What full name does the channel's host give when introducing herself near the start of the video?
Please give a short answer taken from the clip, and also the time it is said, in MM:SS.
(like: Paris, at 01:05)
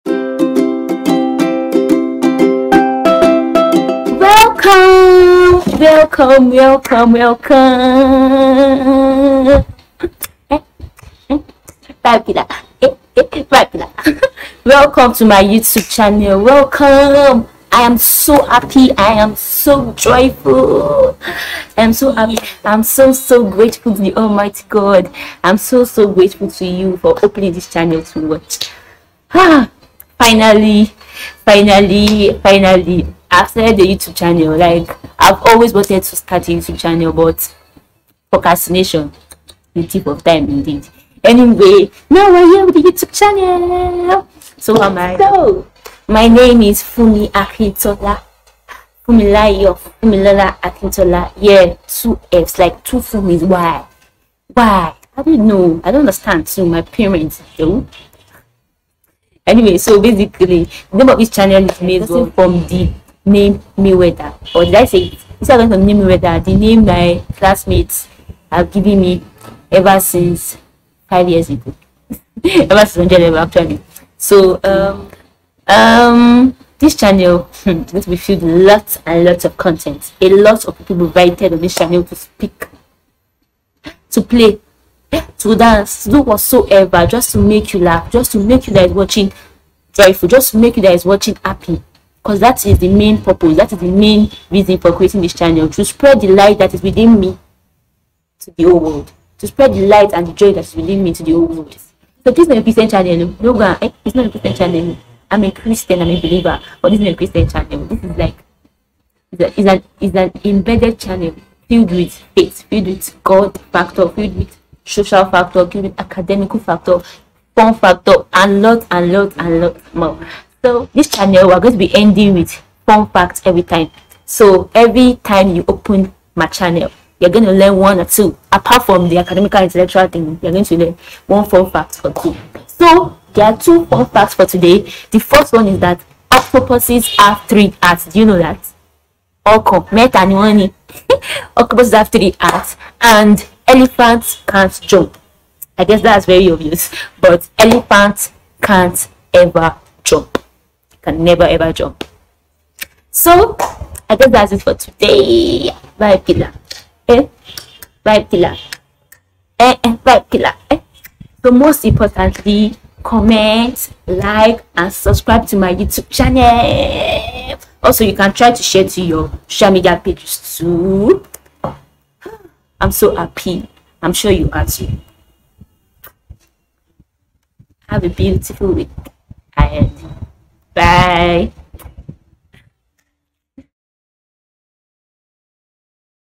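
Fumi Akintola, at 00:46.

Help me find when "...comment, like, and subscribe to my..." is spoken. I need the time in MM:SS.
02:43.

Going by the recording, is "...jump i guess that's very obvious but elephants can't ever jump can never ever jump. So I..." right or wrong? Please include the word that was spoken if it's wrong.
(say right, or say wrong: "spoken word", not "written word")
right.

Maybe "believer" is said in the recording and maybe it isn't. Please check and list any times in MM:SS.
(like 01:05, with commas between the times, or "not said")
01:46.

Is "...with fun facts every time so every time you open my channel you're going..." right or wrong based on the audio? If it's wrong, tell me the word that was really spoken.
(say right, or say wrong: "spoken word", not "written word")
right.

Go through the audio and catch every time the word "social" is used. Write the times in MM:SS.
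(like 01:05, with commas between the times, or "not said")
01:54, 02:49.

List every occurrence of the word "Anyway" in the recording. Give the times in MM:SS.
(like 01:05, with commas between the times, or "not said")
00:41, 00:59.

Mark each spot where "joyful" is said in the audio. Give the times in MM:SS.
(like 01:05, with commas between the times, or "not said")
00:19, 01:29.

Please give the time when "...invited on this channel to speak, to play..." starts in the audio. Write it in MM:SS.
01:21.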